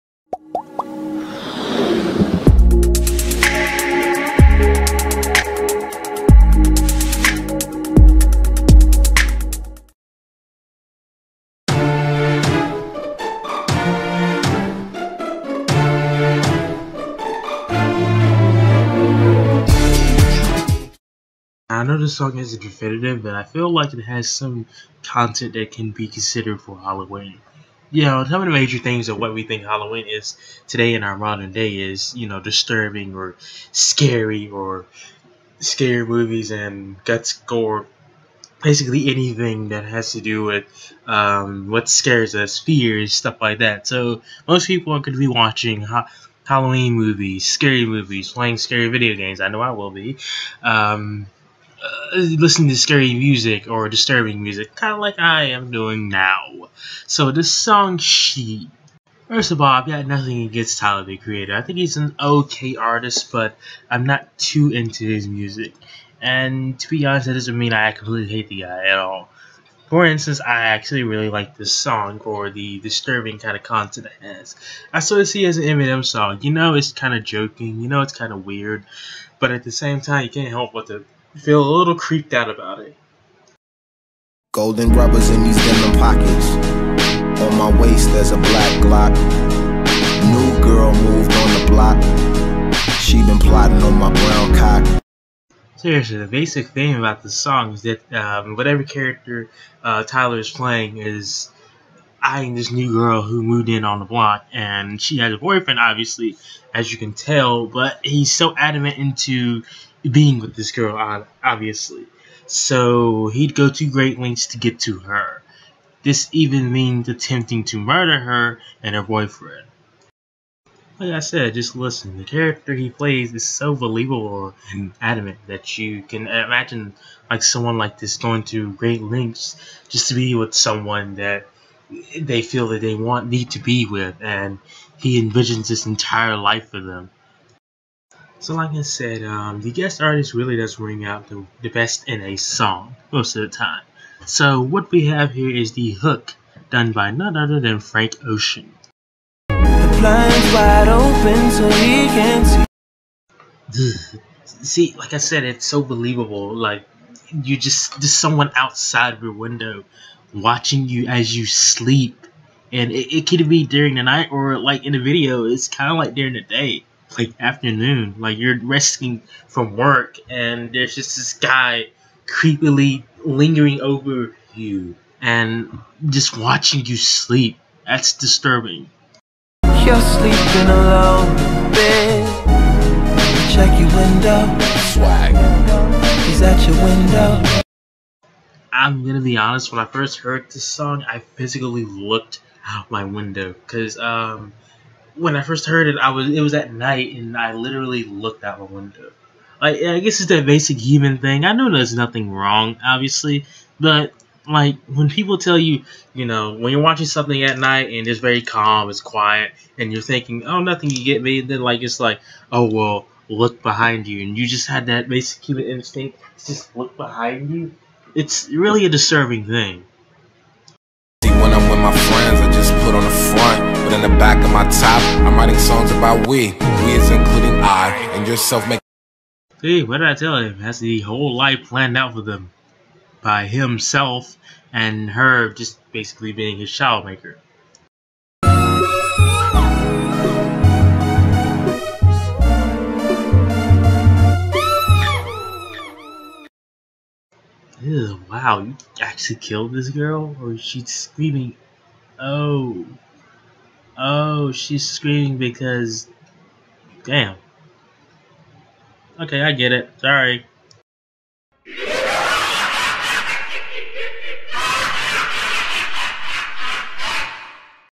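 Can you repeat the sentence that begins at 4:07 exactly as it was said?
Ew, wow, you actually killed this girl?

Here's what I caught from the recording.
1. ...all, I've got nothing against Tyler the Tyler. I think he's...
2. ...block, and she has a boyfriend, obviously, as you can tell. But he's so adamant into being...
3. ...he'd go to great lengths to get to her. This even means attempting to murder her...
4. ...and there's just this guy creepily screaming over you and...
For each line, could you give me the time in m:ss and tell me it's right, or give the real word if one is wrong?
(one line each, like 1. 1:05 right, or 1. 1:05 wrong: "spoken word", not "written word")
1. 0:59 wrong: "Creator", not "Tyler"
2. 1:44 right
3. 1:53 right
4. 2:50 wrong: "lingering", not "screaming".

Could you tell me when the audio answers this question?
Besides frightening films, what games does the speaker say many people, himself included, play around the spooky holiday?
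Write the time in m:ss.
0:48.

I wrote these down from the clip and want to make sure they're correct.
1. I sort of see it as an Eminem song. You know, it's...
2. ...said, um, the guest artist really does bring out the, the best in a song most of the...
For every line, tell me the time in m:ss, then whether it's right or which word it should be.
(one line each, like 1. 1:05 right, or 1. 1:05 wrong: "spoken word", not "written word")
1. 1:14 right
2. 2:18 right.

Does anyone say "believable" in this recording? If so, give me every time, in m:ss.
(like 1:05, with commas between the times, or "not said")
2:03, 2:35.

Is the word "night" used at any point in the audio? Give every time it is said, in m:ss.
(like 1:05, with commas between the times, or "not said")
2:44, 3:16, 3:27.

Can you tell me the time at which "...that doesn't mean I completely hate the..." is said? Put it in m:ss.
1:07.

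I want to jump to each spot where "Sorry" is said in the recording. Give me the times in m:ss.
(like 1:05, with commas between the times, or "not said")
4:19.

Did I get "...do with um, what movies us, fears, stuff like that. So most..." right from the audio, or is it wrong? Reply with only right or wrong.
wrong.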